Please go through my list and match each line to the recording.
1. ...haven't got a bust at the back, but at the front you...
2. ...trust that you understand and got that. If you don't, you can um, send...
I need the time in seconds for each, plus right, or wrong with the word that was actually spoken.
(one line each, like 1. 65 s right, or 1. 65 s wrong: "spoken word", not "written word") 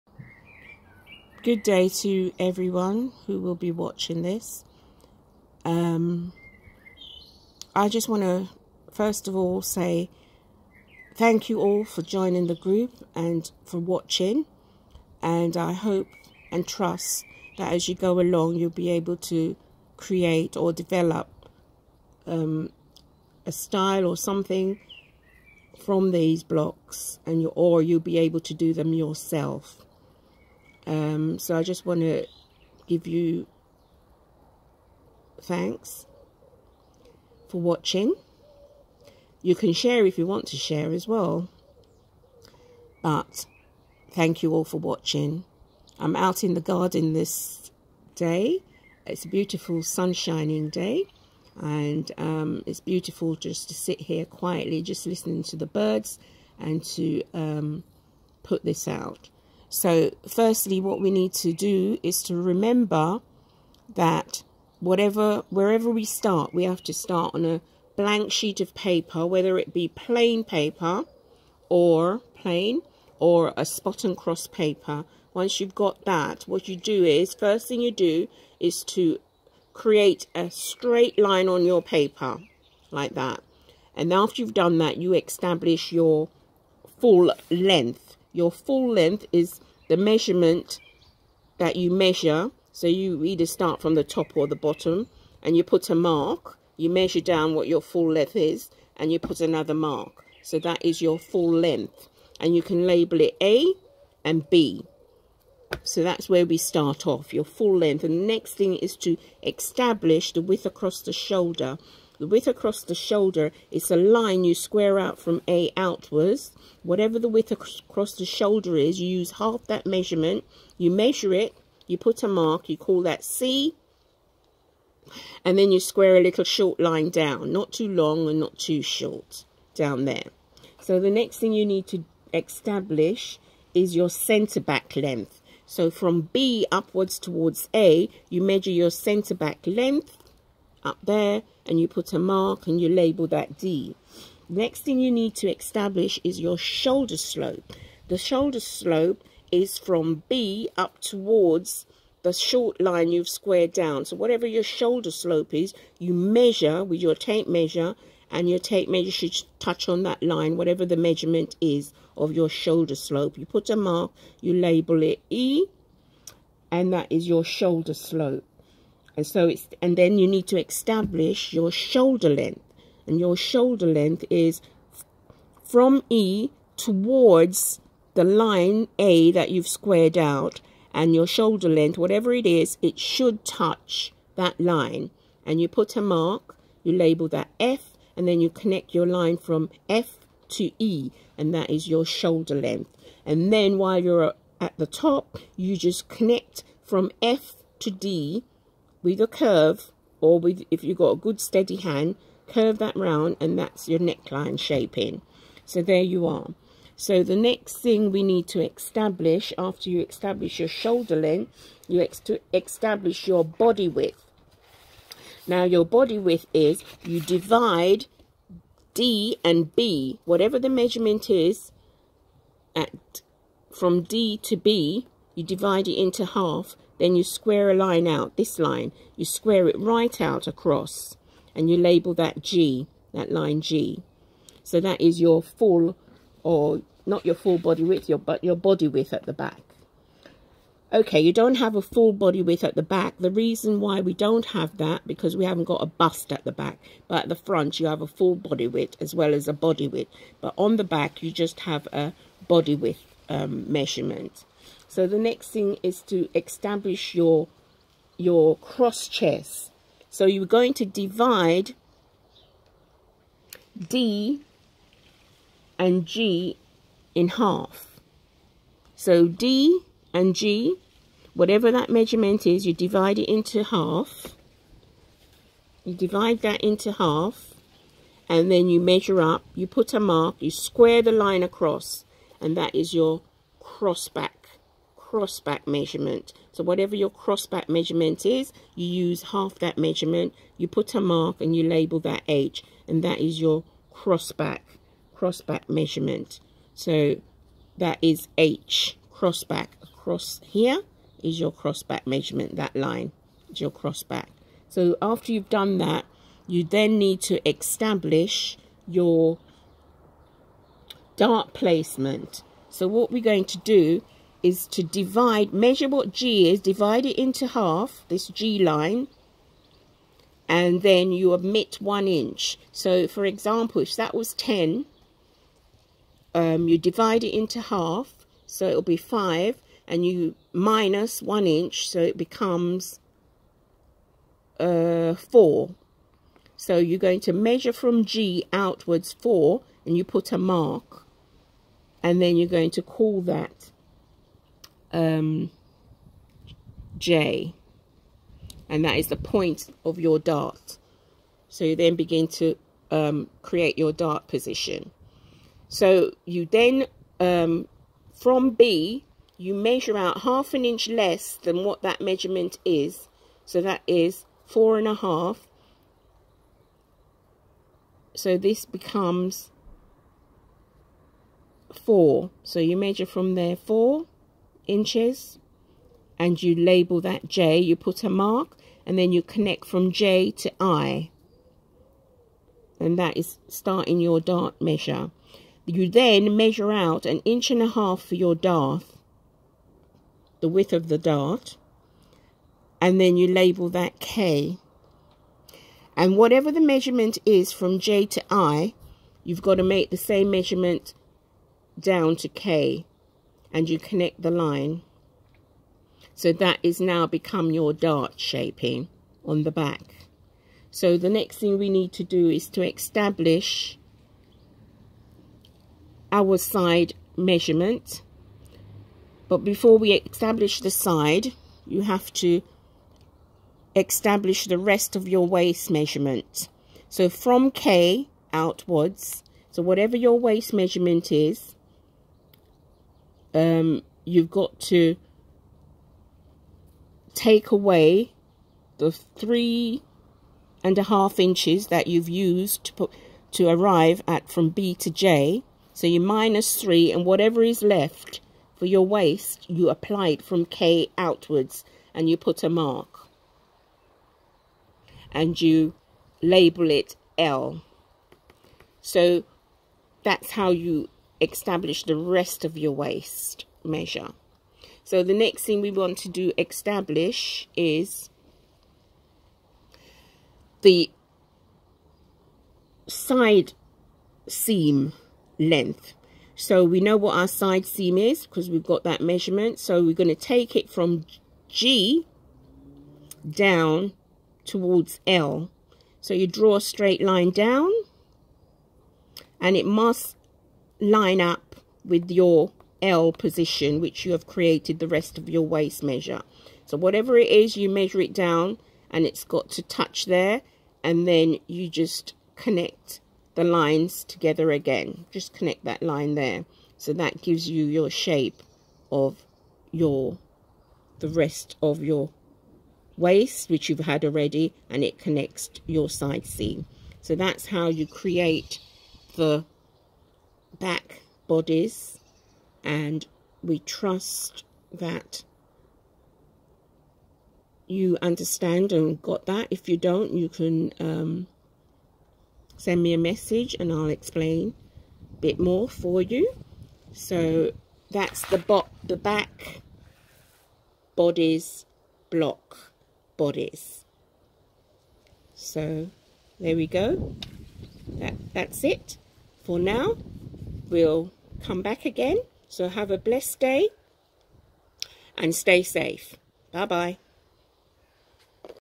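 1. 245 s right
2. 523 s right.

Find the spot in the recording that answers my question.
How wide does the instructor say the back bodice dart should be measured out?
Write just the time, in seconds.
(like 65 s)
387 s.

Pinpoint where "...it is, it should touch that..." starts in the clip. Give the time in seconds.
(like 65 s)
182 s.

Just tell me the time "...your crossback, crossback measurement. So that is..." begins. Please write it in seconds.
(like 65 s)
293 s.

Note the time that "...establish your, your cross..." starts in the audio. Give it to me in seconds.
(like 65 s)
256 s.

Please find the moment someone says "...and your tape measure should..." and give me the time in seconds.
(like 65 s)
158 s.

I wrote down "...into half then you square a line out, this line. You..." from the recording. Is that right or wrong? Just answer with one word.
right.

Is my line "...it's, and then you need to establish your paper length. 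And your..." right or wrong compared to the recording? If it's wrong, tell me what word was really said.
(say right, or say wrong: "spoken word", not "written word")
wrong: "shoulder", not "paper".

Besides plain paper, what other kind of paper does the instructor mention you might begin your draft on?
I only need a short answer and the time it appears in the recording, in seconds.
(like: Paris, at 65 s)
Spot and cross paper, at 73 s.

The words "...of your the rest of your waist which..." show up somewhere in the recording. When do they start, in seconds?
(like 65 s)
508 s.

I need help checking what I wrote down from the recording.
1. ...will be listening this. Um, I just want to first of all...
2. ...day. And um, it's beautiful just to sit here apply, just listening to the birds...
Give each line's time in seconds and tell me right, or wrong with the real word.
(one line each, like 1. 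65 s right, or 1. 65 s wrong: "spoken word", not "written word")
1. 3 s wrong: "watching", not "listening"
2. 50 s wrong: "quietly", not "apply".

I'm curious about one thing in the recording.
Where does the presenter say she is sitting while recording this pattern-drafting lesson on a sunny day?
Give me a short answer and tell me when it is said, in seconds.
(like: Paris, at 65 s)
In the garden, at 46 s.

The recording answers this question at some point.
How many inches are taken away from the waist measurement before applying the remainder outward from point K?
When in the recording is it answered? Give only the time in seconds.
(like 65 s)
438 s.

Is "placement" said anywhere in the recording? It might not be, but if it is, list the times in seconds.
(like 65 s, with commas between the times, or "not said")
311 s.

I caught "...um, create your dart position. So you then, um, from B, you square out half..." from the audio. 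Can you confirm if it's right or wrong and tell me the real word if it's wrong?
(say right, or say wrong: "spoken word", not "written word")
wrong: "measure", not "square".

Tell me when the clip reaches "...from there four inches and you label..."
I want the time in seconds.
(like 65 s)
373 s.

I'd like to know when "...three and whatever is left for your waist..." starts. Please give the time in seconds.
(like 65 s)
446 s.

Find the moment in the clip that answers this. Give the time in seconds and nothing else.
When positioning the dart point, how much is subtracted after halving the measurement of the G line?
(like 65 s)
321 s.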